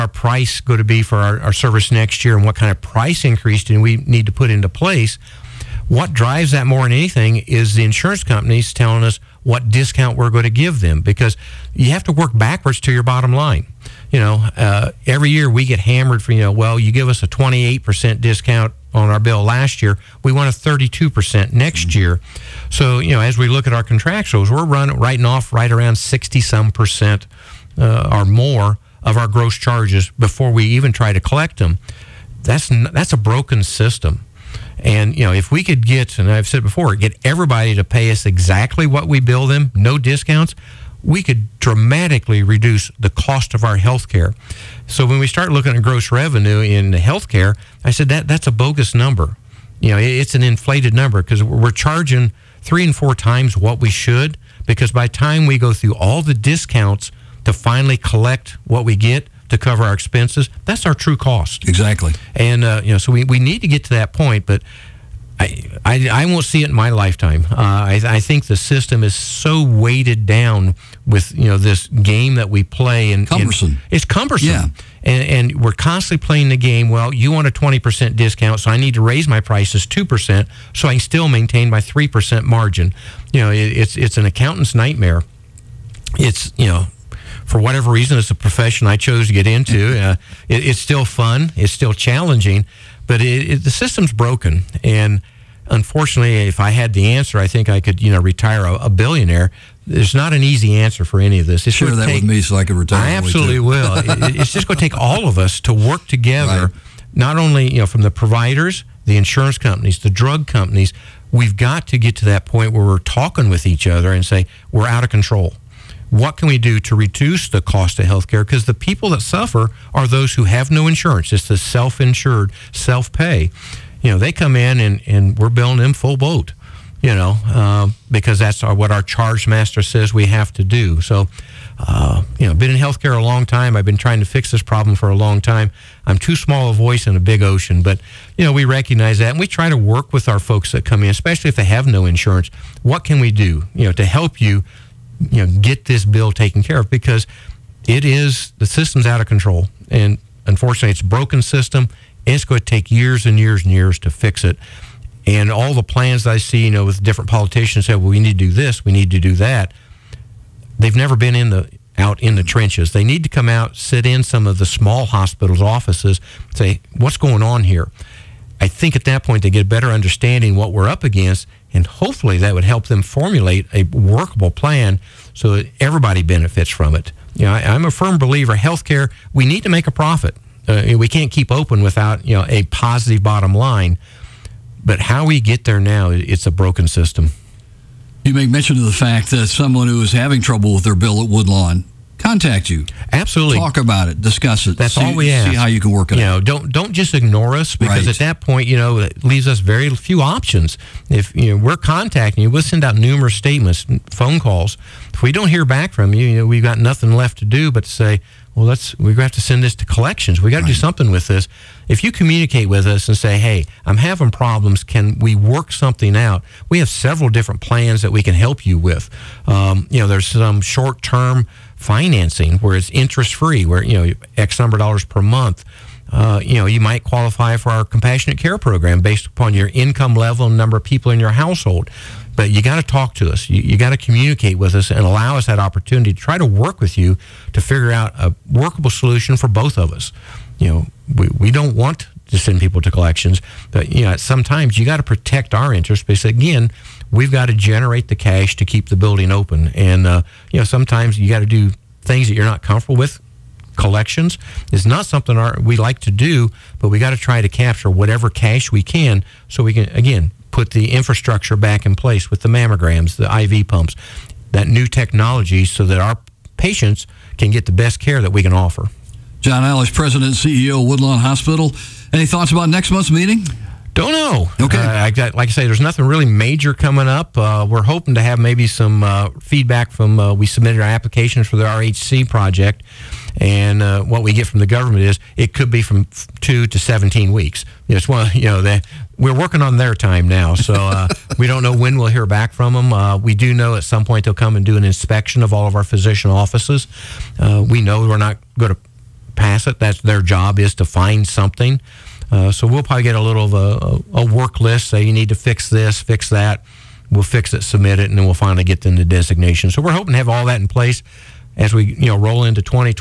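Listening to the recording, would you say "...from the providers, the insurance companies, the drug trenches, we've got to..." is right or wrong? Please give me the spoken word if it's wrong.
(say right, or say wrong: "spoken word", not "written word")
wrong: "companies", not "trenches".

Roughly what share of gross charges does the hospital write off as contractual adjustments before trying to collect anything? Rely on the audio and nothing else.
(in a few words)
60 some percent.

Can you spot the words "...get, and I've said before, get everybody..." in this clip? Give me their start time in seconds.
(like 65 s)
35 s.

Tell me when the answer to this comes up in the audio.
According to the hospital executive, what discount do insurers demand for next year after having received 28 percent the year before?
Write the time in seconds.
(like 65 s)
20 s.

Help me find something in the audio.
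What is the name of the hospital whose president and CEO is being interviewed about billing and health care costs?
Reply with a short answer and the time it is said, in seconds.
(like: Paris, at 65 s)
Woodlawn Hospital, at 270 s.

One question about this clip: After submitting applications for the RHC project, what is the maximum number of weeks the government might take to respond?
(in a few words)
17 weeks.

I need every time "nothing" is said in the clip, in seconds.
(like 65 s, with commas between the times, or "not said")
206 s, 275 s.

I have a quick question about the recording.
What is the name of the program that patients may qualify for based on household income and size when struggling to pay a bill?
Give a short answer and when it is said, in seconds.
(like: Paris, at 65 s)
compassionate care program, at 227 s.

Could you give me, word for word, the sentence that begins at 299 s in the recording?
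That's their job is to find something.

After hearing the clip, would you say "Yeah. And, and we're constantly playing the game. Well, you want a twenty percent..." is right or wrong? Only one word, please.
right.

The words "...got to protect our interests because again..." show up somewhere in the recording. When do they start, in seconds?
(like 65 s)
244 s.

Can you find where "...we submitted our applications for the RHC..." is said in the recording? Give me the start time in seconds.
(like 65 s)
280 s.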